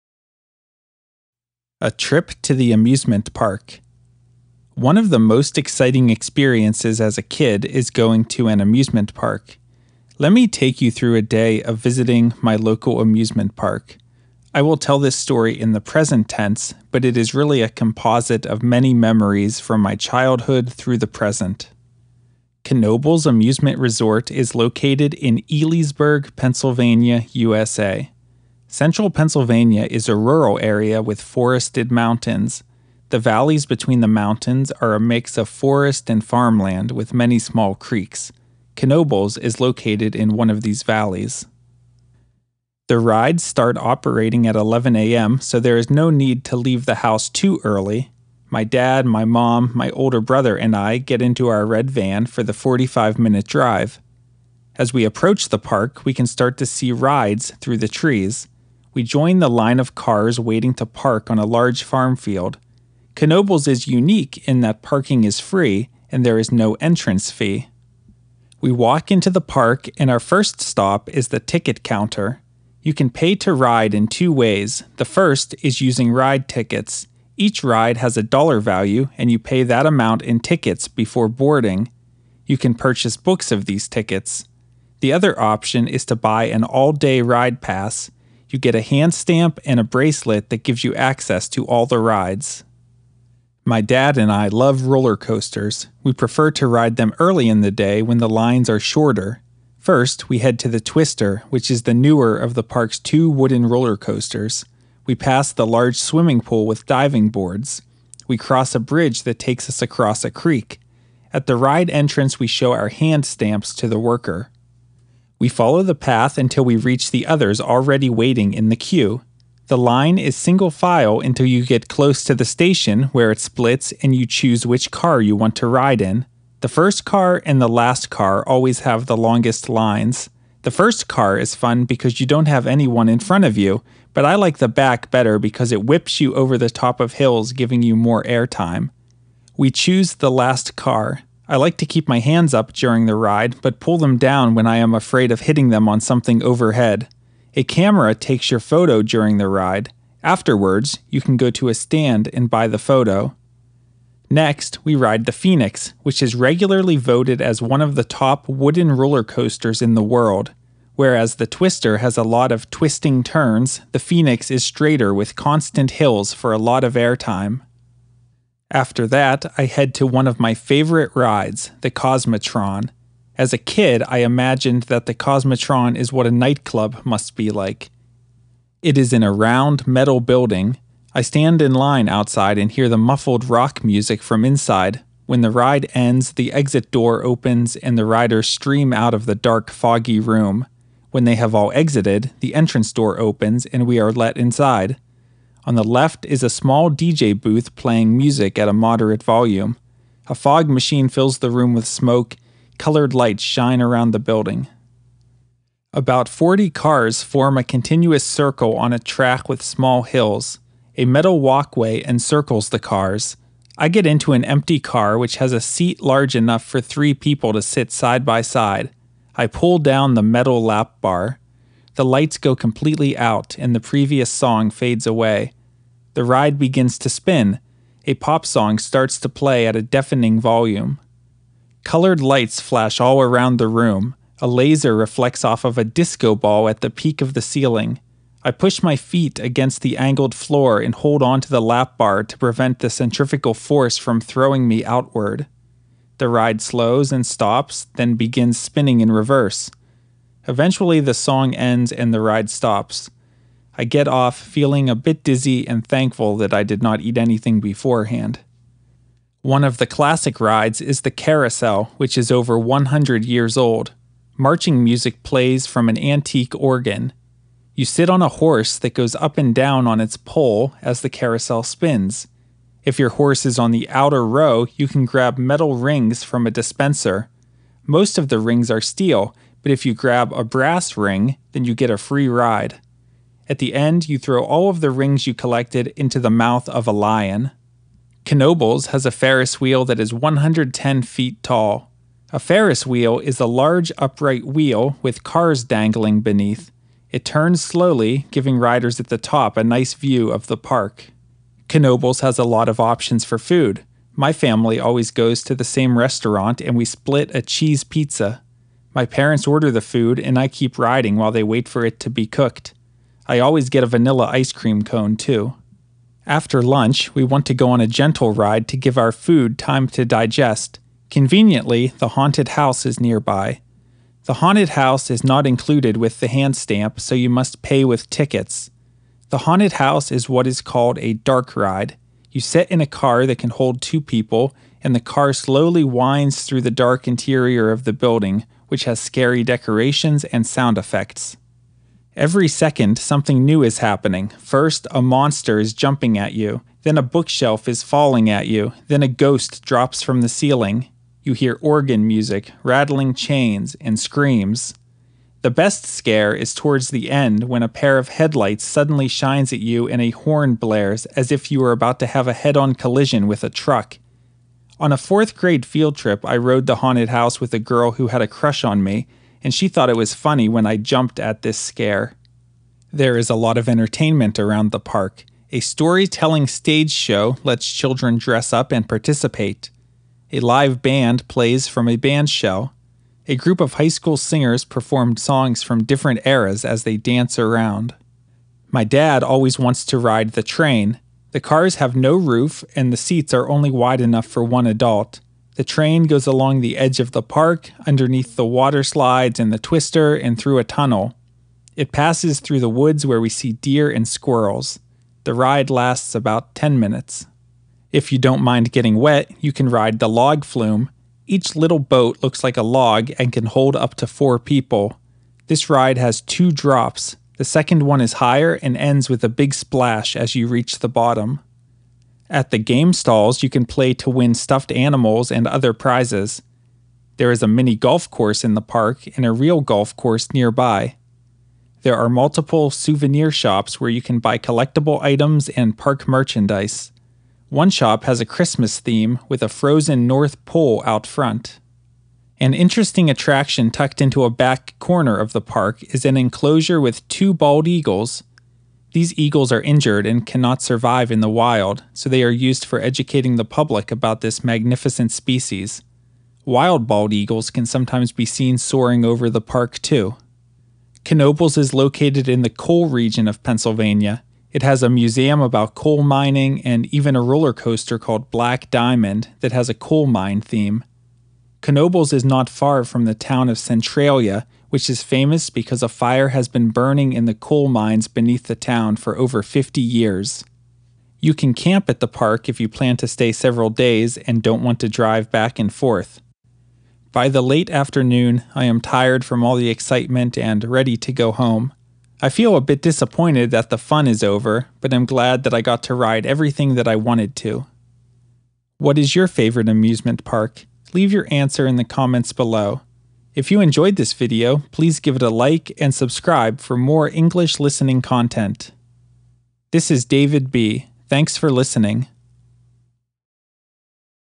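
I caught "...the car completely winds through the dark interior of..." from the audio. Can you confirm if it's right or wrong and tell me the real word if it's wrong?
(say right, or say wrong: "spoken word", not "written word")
wrong: "slowly", not "completely".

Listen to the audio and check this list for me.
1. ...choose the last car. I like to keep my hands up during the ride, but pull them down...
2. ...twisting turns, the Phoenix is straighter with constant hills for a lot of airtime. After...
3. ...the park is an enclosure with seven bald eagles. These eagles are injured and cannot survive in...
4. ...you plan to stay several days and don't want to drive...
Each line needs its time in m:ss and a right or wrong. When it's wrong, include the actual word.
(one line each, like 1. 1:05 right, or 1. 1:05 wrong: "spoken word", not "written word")
1. 2:19 right
2. 2:42 right
3. 7:25 wrong: "two", not "seven"
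4. 8:02 right.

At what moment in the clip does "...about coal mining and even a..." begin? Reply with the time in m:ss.
7:45.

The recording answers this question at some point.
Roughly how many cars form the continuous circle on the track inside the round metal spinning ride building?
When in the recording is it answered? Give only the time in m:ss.
3:26.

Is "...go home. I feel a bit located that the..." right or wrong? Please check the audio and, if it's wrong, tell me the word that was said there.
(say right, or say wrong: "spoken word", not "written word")
wrong: "disappointed", not "located".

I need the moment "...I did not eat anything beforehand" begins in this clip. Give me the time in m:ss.
4:16.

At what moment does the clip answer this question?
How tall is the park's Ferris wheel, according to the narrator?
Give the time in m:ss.
4:50.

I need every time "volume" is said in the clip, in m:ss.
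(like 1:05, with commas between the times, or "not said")
3:19, 3:50.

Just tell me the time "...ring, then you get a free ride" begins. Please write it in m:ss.
4:40.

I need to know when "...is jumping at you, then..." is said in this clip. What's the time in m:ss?
5:45.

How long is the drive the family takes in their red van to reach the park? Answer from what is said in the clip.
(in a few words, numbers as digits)
45 minutes.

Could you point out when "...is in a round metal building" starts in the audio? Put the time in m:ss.
2:58.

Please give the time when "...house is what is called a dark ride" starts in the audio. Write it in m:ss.
5:29.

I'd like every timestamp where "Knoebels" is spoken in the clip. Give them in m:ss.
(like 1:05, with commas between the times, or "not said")
0:22, 0:38, 1:03, 4:48, 5:01, 7:41, 7:51.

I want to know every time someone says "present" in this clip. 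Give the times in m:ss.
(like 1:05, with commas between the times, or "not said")
0:15, 0:21.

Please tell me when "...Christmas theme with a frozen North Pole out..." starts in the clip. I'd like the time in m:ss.
7:18.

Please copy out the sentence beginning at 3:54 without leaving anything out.
A laser reflects off of a disco ball at the peak of the ceiling.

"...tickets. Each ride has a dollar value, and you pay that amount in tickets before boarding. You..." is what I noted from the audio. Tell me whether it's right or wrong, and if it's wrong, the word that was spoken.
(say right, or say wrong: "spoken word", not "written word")
right.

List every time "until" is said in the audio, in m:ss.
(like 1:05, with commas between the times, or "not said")
1:56, 2:01.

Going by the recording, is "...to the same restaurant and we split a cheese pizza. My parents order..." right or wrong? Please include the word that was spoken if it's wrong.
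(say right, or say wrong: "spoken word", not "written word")
right.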